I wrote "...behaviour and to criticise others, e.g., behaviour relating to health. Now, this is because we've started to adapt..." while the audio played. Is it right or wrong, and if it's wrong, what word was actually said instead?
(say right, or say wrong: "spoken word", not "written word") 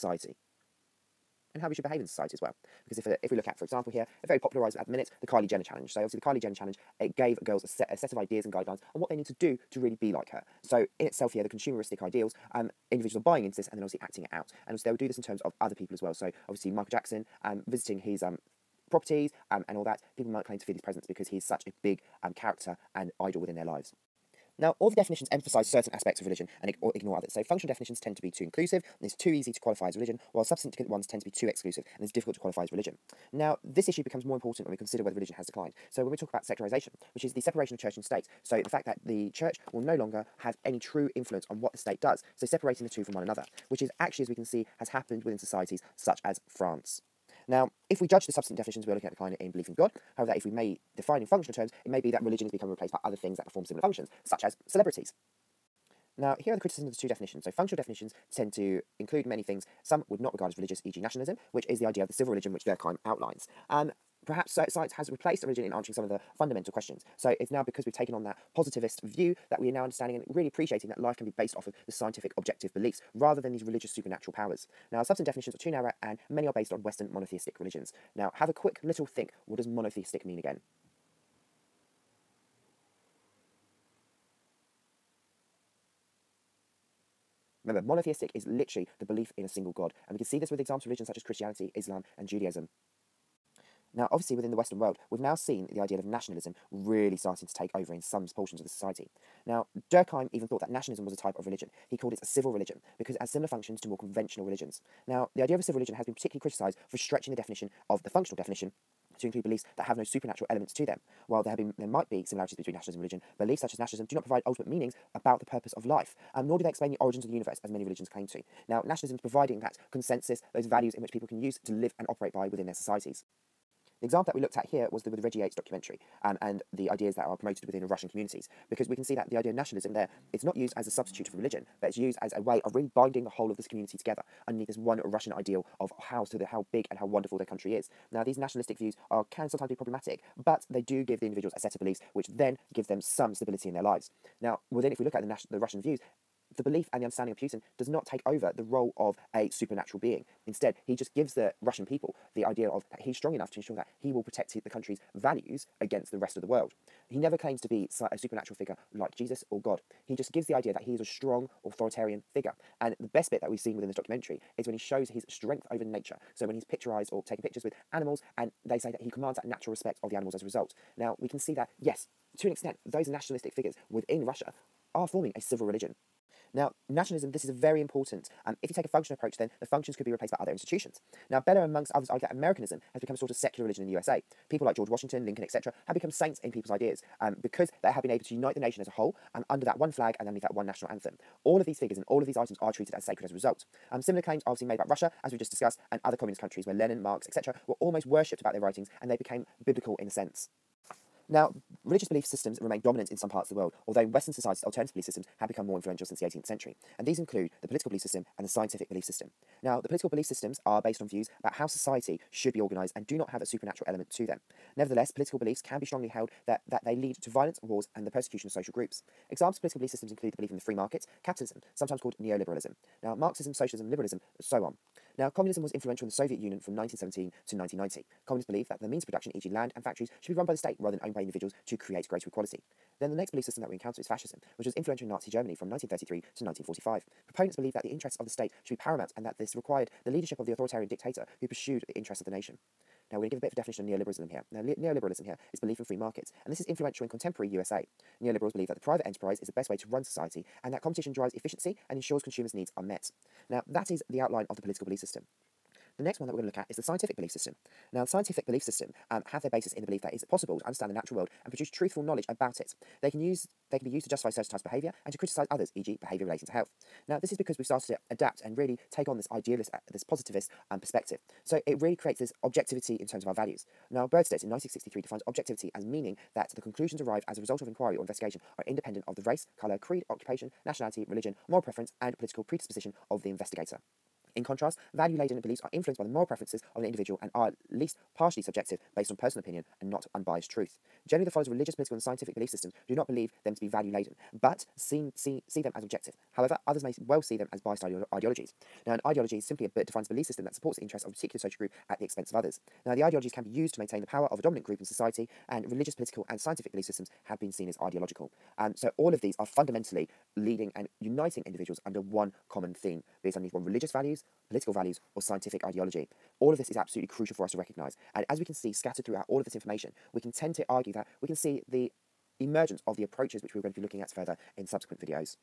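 right.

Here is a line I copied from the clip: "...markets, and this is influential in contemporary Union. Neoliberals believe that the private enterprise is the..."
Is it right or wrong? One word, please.
wrong.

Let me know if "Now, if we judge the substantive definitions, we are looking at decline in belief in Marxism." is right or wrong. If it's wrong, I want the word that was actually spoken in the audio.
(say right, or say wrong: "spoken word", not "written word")
wrong: "God", not "Marxism".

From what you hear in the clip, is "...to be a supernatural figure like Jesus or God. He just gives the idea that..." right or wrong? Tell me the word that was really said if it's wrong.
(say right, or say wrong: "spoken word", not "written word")
right.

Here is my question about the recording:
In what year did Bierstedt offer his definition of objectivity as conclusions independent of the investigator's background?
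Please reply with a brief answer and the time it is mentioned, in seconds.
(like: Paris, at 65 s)
1963, at 274 s.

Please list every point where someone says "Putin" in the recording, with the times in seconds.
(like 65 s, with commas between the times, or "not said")
147 s.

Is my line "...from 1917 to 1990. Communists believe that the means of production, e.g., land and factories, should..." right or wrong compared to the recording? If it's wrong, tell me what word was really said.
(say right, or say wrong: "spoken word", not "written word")
right.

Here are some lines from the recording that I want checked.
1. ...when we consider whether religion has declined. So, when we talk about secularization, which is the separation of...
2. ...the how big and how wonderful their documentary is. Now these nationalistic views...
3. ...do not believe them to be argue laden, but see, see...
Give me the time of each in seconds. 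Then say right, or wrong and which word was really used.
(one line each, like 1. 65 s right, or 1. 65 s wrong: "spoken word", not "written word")
1. 34 s right
2. 136 s wrong: "country", not "documentary"
3. 292 s wrong: "value", not "argue".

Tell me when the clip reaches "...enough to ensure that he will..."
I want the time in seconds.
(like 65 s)
153 s.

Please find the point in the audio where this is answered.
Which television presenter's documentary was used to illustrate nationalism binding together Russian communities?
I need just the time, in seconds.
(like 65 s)
125 s.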